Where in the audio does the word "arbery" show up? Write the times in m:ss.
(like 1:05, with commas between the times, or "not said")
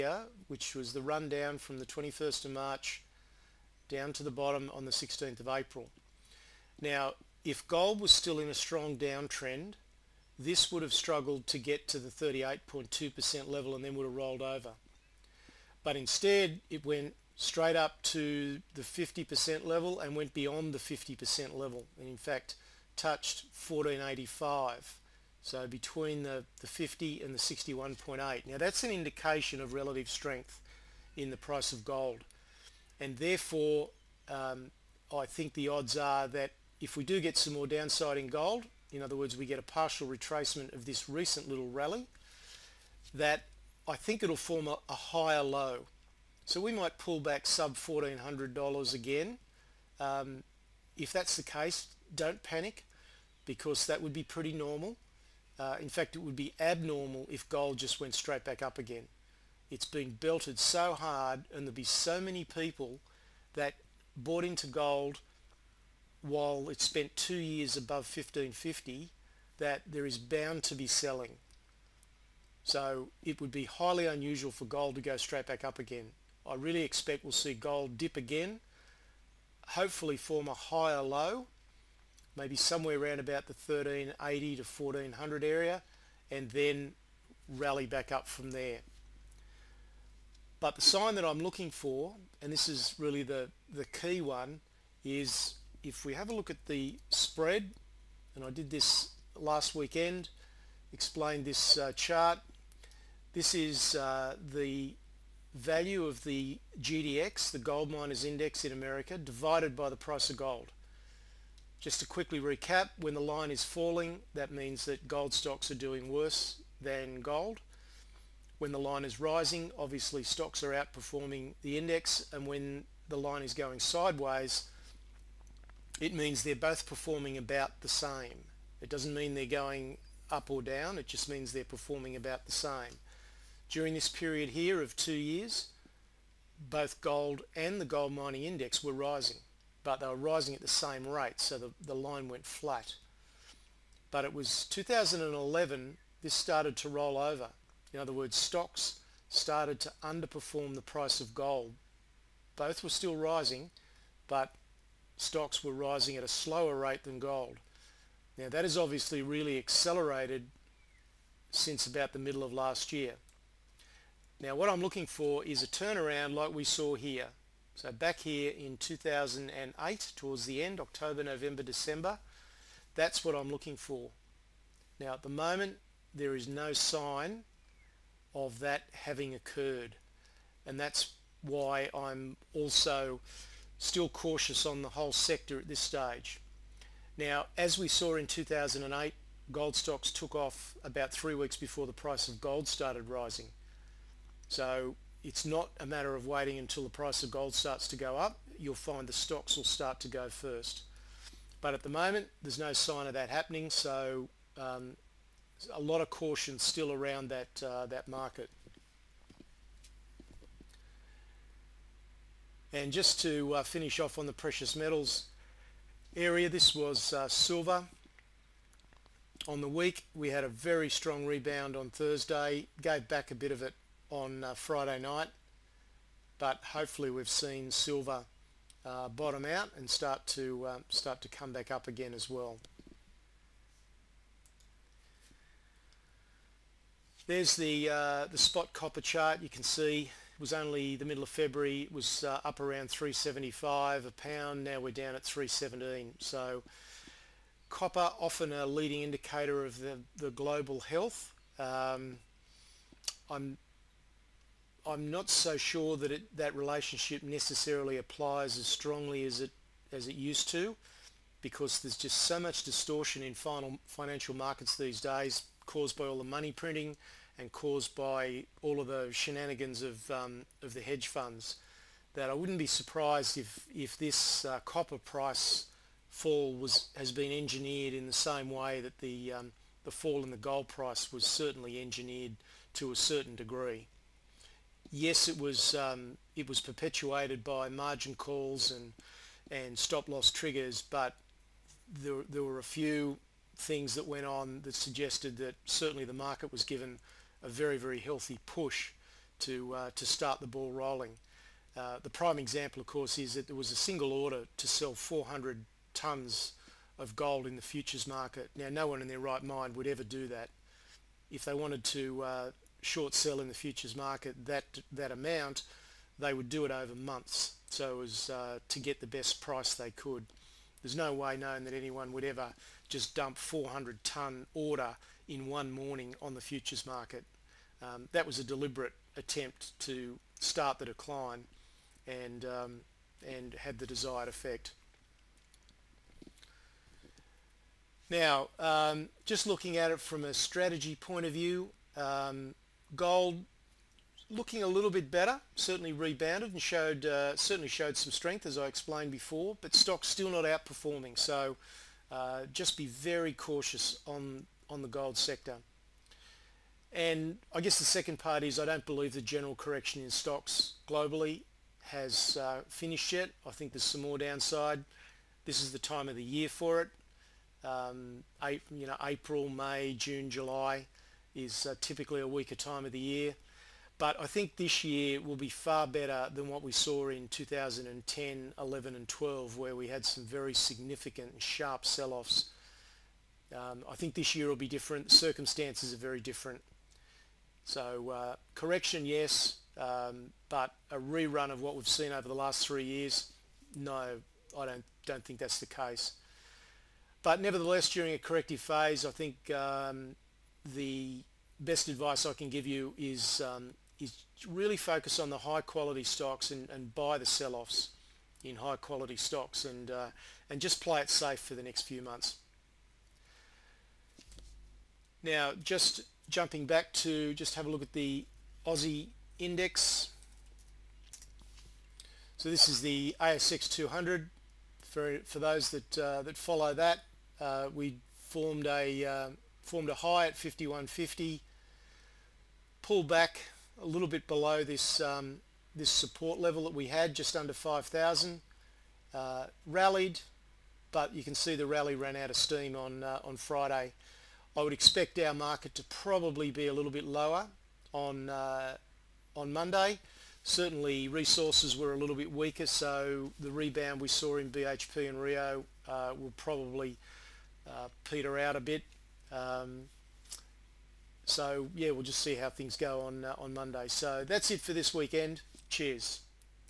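not said.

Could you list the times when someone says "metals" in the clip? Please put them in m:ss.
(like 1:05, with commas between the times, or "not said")
3:34.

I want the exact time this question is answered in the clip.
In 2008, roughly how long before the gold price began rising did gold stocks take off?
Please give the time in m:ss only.
3:11.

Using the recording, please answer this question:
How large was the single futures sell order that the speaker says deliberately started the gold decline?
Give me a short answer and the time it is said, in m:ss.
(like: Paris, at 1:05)
400 tons, at 5:04.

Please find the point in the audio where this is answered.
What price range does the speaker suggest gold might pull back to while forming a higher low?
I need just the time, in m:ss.
1:23.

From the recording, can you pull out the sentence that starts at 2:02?
And when the line is going sideways, it means they're both performing about the same.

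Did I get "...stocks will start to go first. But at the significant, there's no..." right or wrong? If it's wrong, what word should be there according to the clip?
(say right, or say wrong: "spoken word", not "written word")
wrong: "moment", not "significant".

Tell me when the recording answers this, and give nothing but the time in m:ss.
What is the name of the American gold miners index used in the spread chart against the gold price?
1:46.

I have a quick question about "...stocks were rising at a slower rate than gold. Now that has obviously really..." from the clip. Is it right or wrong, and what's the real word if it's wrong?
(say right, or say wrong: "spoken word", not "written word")
right.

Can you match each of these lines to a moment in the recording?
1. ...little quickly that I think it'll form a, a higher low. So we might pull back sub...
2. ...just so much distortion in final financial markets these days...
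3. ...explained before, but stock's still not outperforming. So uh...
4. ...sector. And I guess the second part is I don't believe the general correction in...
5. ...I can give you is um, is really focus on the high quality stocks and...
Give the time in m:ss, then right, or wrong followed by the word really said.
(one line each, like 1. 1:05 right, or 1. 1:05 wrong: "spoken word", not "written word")
1. 0:41 wrong: "rally", not "quickly"
2. 4:21 right
3. 5:48 right
4. 5:55 right
5. 6:42 right.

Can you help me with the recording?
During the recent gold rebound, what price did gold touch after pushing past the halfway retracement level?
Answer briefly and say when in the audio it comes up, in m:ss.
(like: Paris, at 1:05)
1485, at 0:23.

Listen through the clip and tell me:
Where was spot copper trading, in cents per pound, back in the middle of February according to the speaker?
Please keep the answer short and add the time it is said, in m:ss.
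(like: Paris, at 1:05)
375, at 4:02.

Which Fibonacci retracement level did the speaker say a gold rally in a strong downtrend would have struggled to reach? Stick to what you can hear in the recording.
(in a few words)
38.2%.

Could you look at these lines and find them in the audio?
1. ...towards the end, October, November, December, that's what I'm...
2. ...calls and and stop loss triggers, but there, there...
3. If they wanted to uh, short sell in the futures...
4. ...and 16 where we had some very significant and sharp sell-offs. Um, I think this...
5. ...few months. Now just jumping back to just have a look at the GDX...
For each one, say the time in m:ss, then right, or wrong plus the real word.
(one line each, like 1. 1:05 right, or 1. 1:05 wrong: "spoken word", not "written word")
1. 2:50 right
2. 4:48 right
3. 5:11 right
4. 6:18 wrong: "12", not "16"
5. 6:51 wrong: "Aussie", not "GDX".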